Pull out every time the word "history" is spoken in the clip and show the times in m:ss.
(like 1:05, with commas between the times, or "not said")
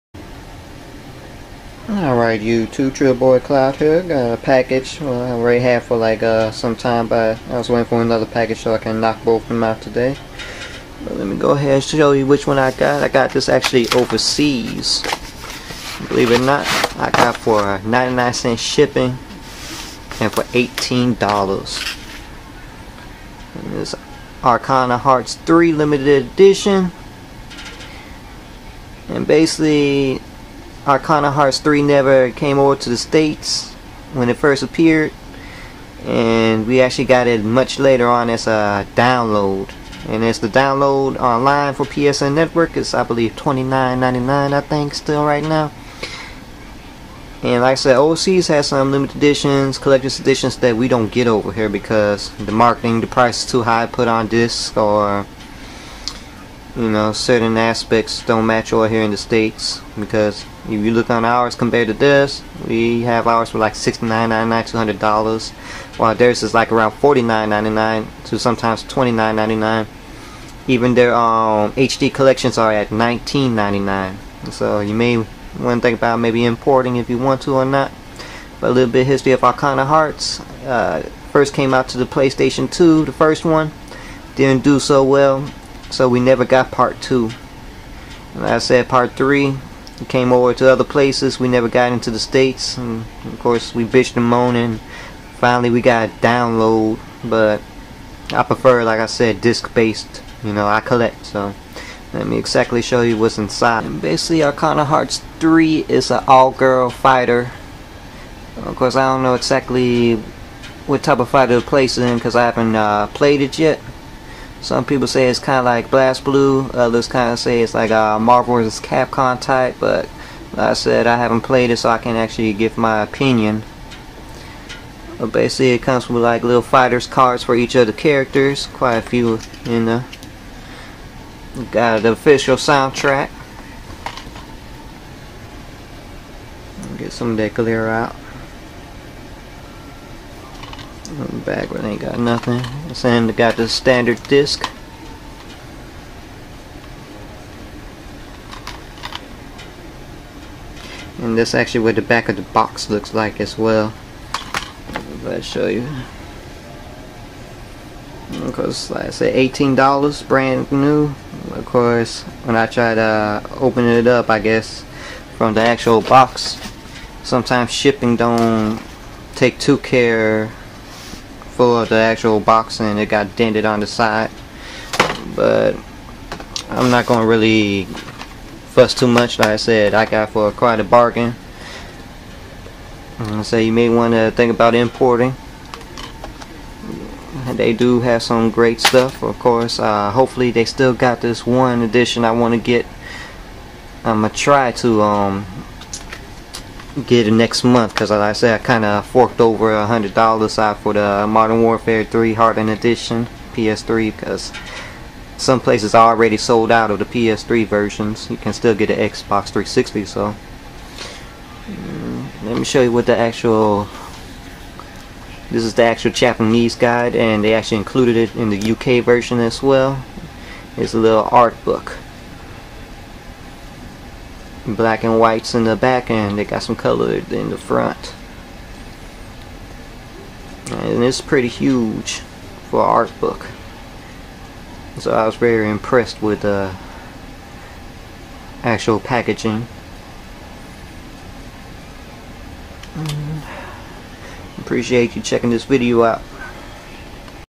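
1:19.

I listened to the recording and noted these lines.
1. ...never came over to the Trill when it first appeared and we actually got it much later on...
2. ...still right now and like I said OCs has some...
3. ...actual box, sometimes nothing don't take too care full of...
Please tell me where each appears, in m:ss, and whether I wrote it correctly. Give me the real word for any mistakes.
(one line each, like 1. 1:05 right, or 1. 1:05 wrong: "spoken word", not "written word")
1. 0:31 wrong: "States", not "Trill"
2. 0:44 right
3. 2:45 wrong: "shipping", not "nothing".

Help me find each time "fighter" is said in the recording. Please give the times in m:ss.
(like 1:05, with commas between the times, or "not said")
1:46, 1:51, 2:06.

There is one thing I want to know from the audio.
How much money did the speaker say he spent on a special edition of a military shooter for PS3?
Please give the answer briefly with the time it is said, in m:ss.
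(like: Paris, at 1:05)
$100, at 3:19.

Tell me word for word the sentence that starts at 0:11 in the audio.
But let me go ahead and show you which one I got.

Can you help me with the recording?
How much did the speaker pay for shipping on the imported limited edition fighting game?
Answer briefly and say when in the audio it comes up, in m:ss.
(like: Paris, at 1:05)
99 cents, at 0:17.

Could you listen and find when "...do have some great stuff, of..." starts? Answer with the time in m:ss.
3:07.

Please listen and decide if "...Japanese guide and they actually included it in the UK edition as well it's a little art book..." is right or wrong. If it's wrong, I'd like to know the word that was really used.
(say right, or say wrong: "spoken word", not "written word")
wrong: "version", not "edition".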